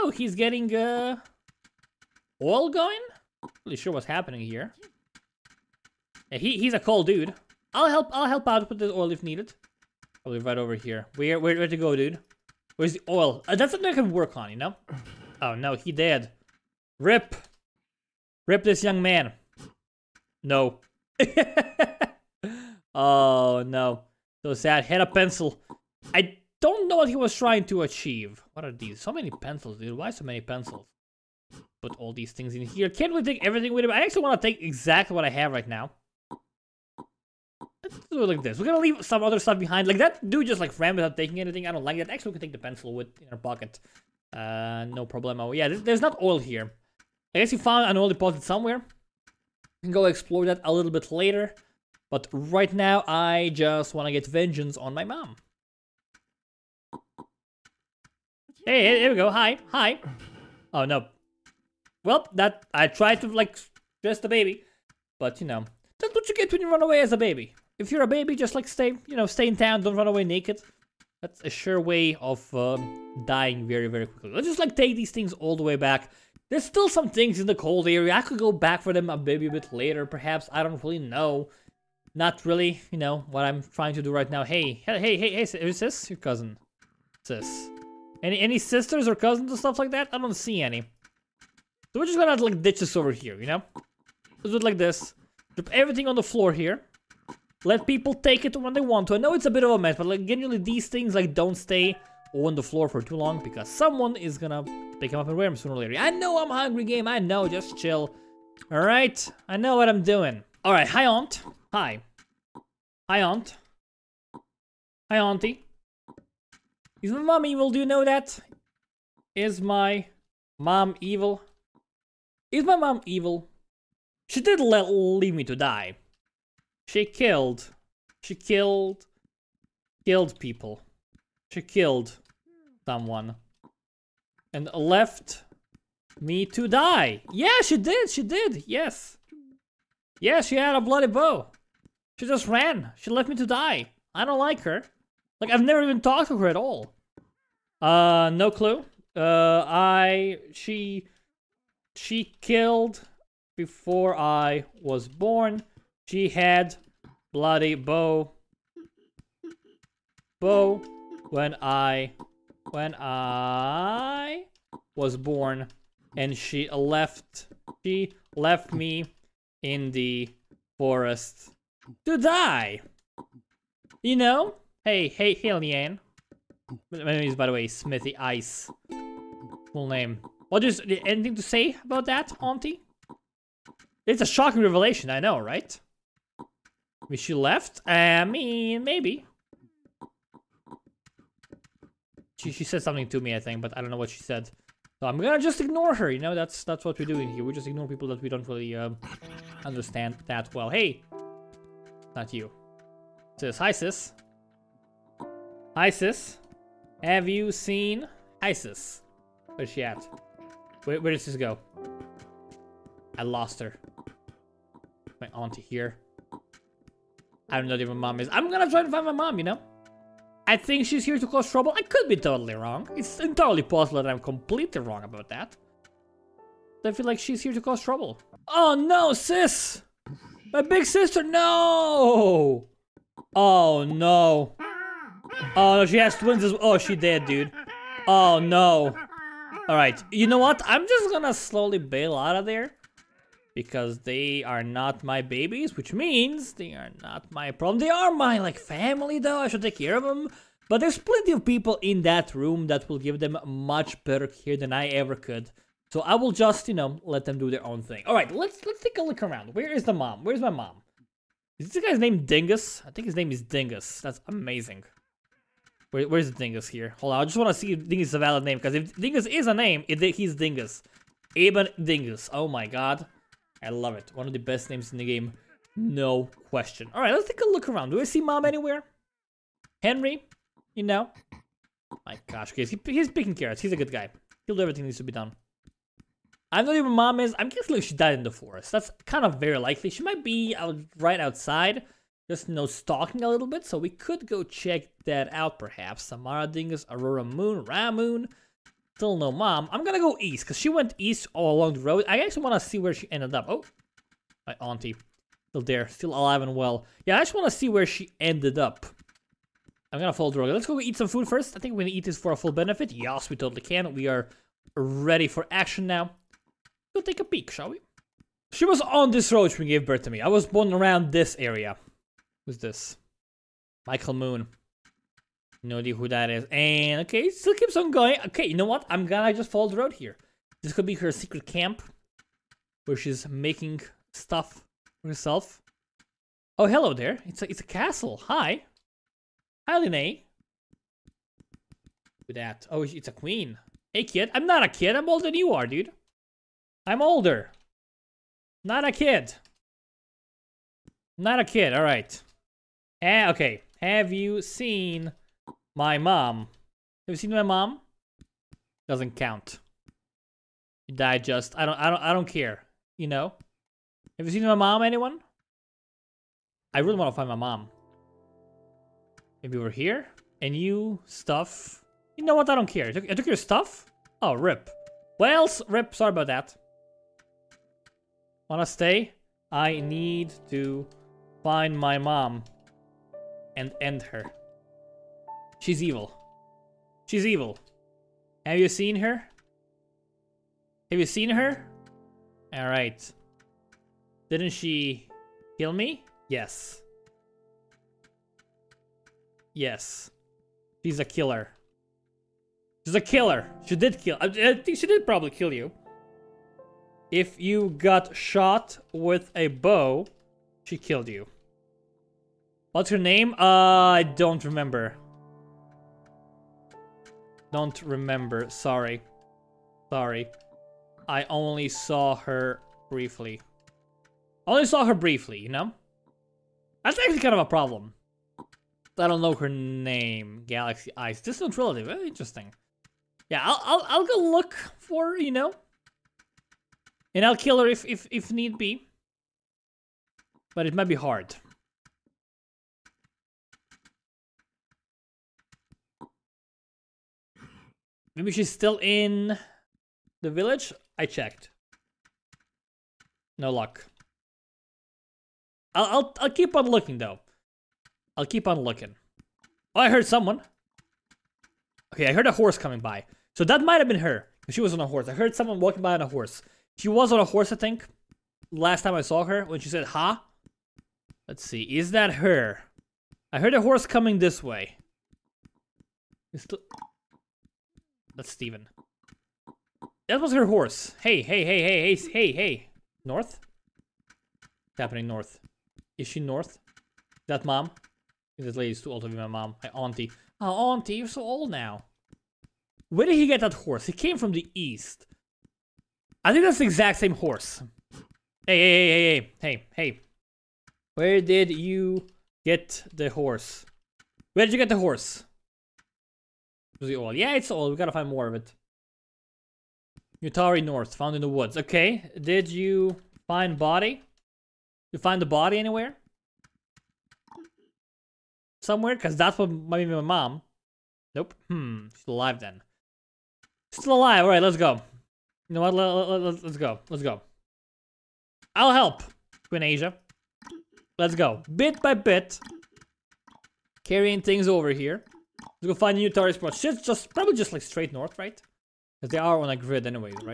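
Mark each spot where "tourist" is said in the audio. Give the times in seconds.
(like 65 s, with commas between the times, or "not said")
536 s.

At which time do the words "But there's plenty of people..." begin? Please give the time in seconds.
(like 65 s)
250 s.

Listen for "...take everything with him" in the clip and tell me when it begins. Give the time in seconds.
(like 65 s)
33 s.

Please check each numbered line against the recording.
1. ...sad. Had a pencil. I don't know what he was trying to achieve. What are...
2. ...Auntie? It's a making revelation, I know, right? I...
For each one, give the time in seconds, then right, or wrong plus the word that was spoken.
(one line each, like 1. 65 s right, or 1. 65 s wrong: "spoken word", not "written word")
1. 24 s right
2. 182 s wrong: "shocking", not "making".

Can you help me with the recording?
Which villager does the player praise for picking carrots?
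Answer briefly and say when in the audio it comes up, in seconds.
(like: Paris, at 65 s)
Henry, at 279 s.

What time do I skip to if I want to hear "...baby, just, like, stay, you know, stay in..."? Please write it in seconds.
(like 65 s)
68 s.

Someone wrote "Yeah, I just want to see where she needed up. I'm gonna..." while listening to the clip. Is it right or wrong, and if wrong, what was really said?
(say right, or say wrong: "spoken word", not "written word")
wrong: "ended", not "needed".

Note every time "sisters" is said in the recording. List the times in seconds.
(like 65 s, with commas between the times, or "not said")
88 s, 230 s.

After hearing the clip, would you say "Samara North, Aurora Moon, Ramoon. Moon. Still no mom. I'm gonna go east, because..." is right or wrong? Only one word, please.
wrong.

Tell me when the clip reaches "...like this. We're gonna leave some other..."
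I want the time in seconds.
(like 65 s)
38 s.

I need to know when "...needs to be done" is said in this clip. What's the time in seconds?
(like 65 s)
284 s.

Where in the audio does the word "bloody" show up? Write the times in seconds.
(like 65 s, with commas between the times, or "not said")
140 s, 157 s.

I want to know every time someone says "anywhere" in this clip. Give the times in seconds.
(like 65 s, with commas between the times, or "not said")
278 s, 515 s.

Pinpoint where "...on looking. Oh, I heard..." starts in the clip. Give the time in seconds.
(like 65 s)
458 s.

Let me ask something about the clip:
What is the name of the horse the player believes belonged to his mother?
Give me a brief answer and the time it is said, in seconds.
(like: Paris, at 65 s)
Steven, at 478 s.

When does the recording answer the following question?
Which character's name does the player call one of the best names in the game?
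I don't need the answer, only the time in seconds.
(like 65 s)
271 s.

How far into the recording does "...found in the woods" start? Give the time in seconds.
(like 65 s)
510 s.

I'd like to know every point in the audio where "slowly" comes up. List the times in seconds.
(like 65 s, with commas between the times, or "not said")
241 s.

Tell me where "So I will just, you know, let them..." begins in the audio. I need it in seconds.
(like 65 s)
255 s.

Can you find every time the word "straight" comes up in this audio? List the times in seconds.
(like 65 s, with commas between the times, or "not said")
537 s.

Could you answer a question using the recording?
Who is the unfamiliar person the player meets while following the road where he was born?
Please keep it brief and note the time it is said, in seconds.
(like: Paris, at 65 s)
Michael Moon, at 323 s.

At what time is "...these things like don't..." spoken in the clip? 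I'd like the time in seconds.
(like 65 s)
100 s.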